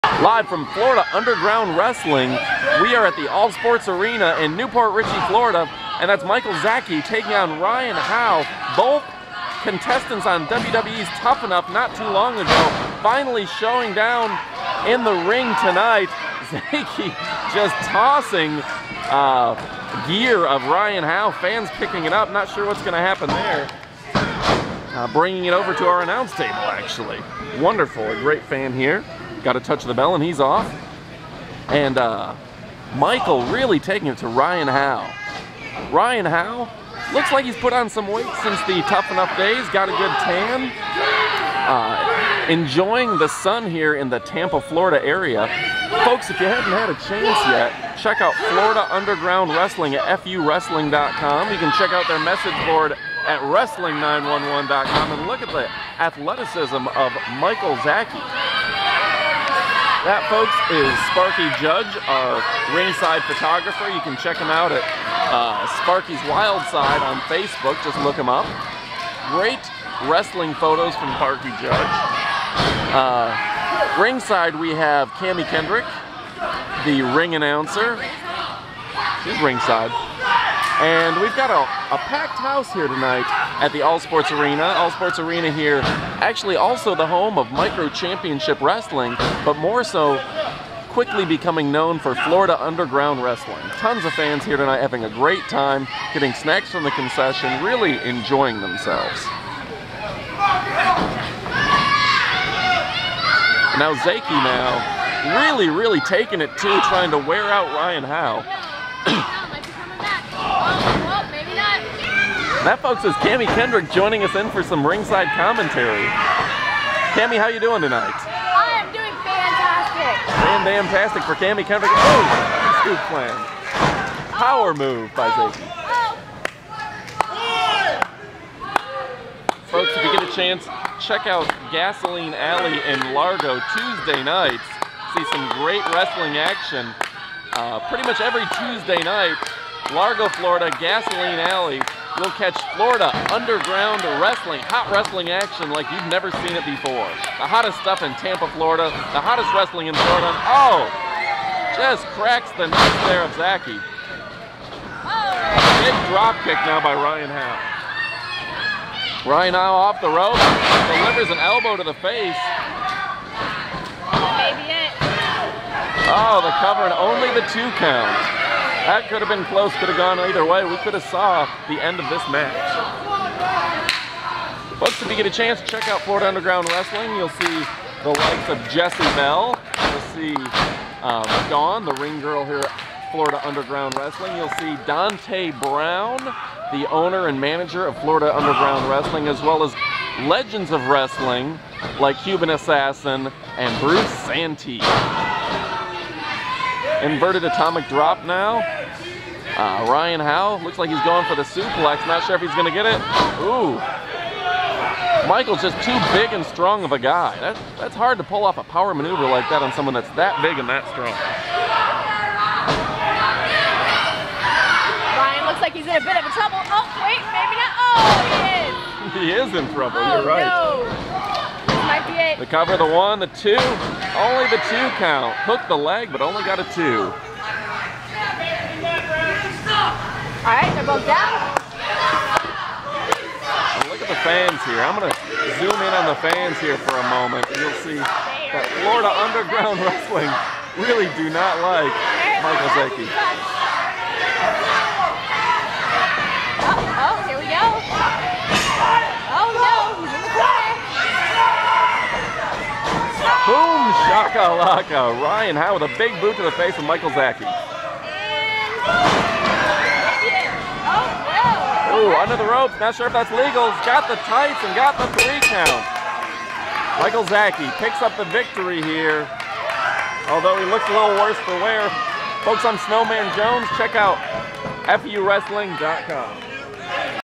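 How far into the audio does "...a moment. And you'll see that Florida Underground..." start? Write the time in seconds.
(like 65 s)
236 s.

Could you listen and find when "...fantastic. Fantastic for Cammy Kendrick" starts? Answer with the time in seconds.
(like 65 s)
119 s.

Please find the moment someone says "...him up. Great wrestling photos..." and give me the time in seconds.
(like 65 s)
68 s.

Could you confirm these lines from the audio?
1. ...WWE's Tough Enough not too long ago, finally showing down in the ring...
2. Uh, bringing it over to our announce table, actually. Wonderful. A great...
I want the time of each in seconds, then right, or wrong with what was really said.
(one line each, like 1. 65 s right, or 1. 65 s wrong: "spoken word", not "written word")
1. 10 s right
2. 24 s right.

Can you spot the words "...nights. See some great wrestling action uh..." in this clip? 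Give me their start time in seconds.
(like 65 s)
134 s.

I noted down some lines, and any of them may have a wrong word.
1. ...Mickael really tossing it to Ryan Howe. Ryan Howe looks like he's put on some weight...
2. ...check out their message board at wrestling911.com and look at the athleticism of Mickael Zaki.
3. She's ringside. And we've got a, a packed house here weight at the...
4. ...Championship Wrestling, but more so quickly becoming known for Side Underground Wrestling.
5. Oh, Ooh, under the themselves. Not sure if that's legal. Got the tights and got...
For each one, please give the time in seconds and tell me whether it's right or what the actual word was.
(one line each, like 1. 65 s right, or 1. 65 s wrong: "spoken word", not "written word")
1. 32 s wrong: "taking", not "tossing"
2. 51 s right
3. 79 s wrong: "tonight", not "weight"
4. 87 s wrong: "Florida", not "Side"
5. 257 s wrong: "ropes", not "themselves".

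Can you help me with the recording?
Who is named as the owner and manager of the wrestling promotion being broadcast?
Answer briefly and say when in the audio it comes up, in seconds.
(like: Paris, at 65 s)
Dante Brown, at 184 s.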